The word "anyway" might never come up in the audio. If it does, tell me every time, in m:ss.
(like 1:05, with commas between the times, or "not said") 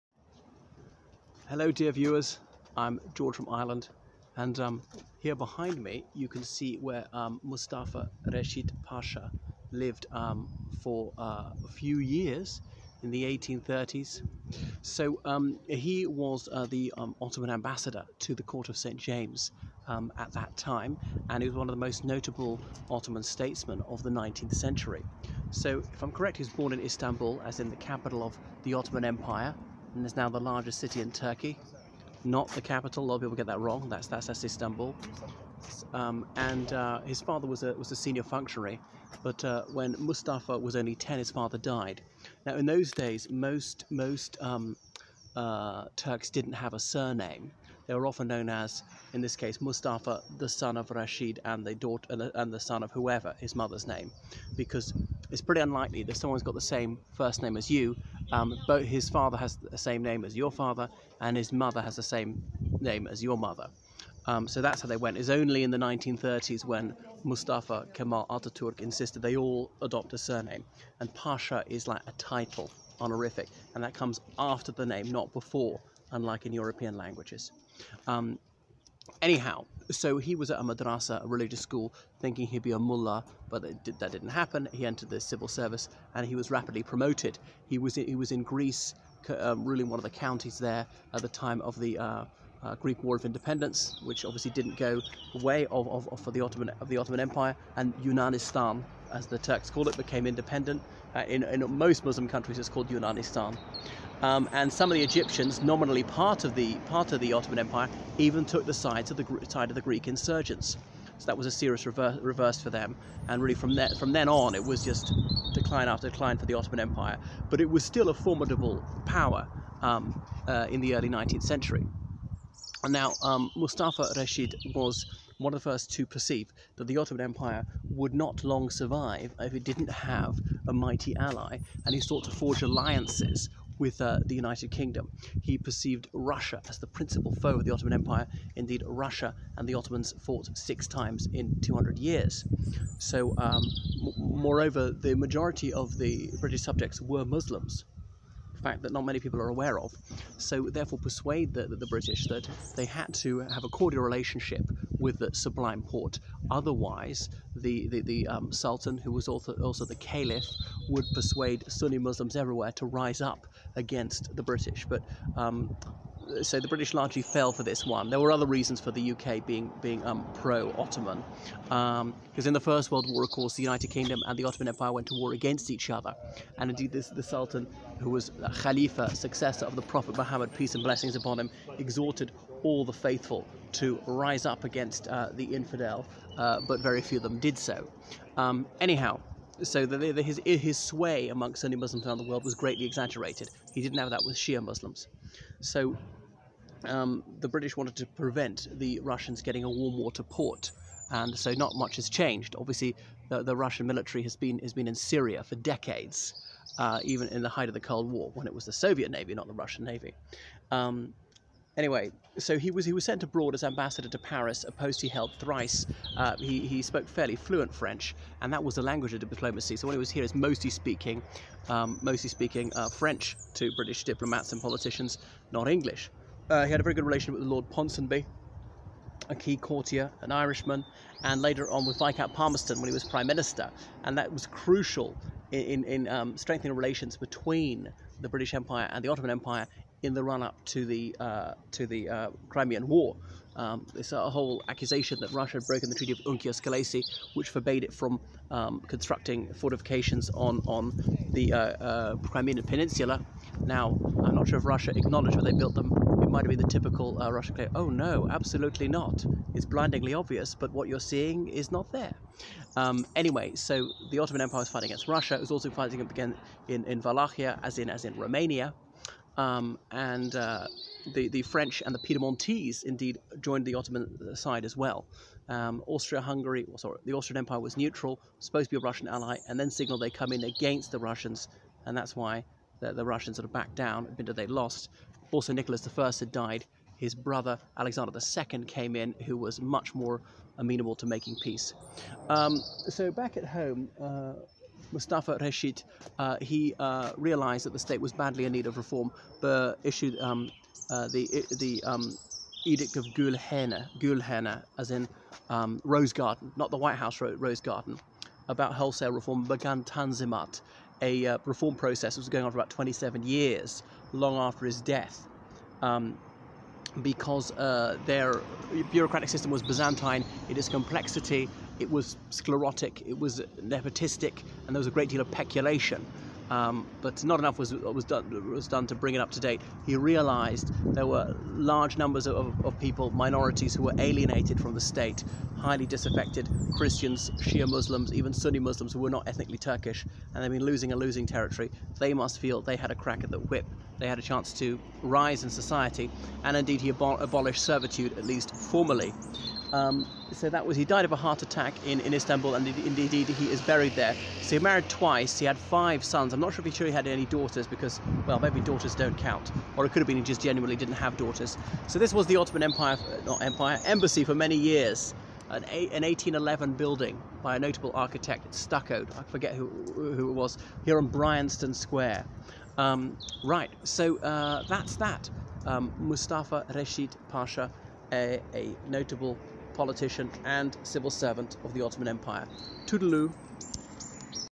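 3:31, 4:23.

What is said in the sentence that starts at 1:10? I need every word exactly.
And Pasha is like a title, honorific, and that comes after the name, not before unlike in European languages.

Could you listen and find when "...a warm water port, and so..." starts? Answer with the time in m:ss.
3:19.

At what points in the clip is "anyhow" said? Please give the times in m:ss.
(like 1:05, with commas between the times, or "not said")
1:19, 3:08.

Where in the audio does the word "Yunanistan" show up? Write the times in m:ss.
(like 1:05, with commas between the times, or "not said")
1:38, 1:42.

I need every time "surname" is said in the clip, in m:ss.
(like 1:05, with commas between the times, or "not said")
0:46, 1:10.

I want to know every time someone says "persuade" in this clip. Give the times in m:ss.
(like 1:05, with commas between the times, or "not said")
2:30, 2:41.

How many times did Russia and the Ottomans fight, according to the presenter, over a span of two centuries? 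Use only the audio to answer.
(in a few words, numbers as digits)
6.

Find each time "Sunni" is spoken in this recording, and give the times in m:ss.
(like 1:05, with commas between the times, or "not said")
2:41, 3:11, 5:38.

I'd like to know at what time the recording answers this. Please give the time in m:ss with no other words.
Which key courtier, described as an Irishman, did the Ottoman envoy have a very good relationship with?
3:47.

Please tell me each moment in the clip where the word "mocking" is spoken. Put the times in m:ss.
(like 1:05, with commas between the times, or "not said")
not said.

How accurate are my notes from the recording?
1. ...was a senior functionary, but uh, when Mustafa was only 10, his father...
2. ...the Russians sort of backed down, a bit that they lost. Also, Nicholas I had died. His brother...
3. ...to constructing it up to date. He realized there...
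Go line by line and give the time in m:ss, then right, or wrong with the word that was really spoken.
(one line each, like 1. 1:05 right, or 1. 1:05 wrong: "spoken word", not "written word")
1. 0:37 right
2. 4:42 right
3. 5:28 wrong: "bring", not "constructing".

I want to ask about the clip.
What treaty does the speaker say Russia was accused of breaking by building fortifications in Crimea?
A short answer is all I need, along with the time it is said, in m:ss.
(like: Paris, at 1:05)
Treaty of Unkiar Skelessi, at 4:05.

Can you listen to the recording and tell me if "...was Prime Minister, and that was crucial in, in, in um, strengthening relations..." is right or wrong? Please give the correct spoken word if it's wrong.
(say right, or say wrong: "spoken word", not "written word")
right.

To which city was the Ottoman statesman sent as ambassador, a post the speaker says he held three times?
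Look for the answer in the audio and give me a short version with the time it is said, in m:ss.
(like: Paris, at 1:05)
Paris, at 3:34.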